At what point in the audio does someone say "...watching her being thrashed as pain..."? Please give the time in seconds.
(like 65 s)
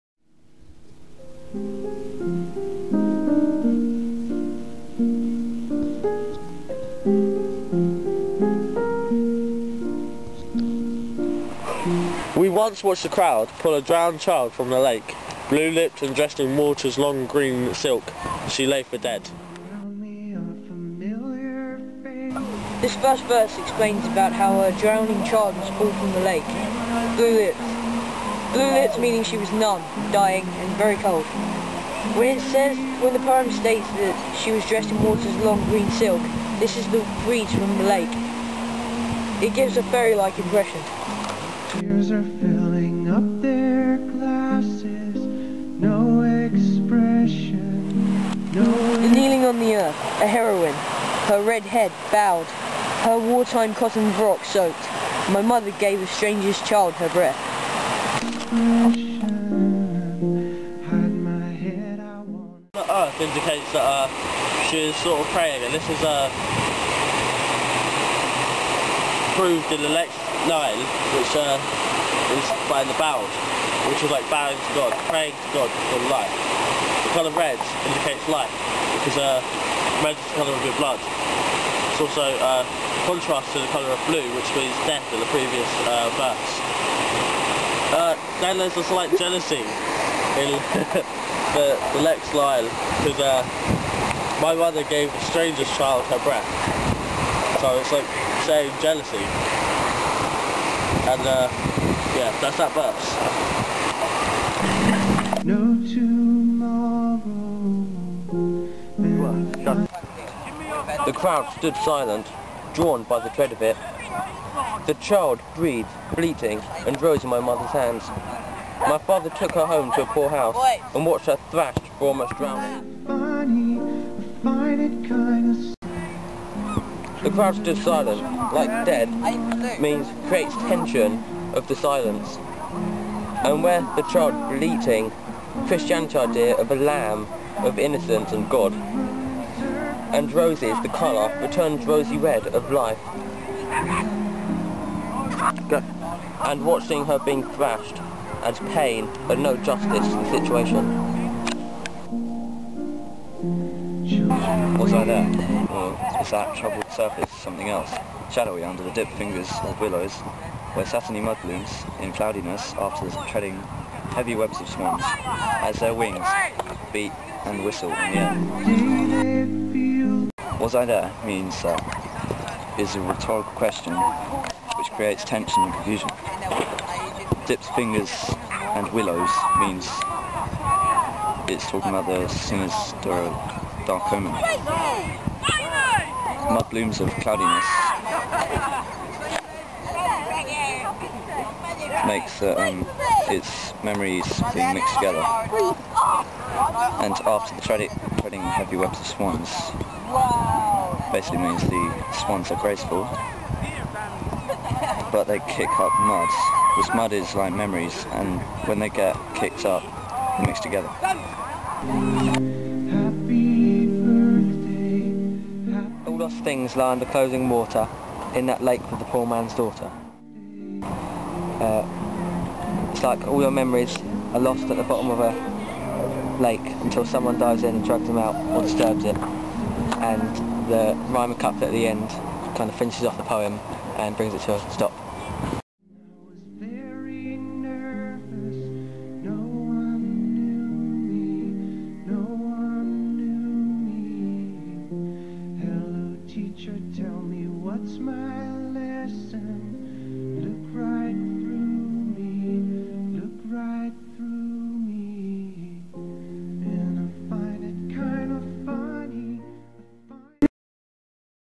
146 s.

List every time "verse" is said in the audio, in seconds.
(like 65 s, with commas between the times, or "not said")
23 s, 86 s, 102 s.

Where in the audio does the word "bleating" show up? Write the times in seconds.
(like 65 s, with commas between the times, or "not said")
116 s, 134 s.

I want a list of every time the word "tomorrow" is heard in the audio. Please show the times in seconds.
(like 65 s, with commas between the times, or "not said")
105 s.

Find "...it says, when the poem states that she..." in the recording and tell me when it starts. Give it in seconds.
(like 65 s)
32 s.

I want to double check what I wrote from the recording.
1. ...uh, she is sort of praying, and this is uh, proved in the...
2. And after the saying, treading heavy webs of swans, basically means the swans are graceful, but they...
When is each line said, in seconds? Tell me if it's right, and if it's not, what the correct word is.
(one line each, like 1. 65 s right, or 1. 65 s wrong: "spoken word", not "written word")
1. 63 s right
2. 197 s wrong: "treading", not "saying".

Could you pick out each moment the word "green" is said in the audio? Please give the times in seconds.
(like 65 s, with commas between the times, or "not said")
17 s, 35 s.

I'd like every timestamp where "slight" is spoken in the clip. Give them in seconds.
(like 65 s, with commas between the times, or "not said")
88 s.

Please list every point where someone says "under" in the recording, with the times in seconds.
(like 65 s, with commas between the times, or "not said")
158 s, 216 s.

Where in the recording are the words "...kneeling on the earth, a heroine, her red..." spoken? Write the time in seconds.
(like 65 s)
49 s.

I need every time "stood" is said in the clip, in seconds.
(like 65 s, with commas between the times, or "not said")
111 s, 127 s.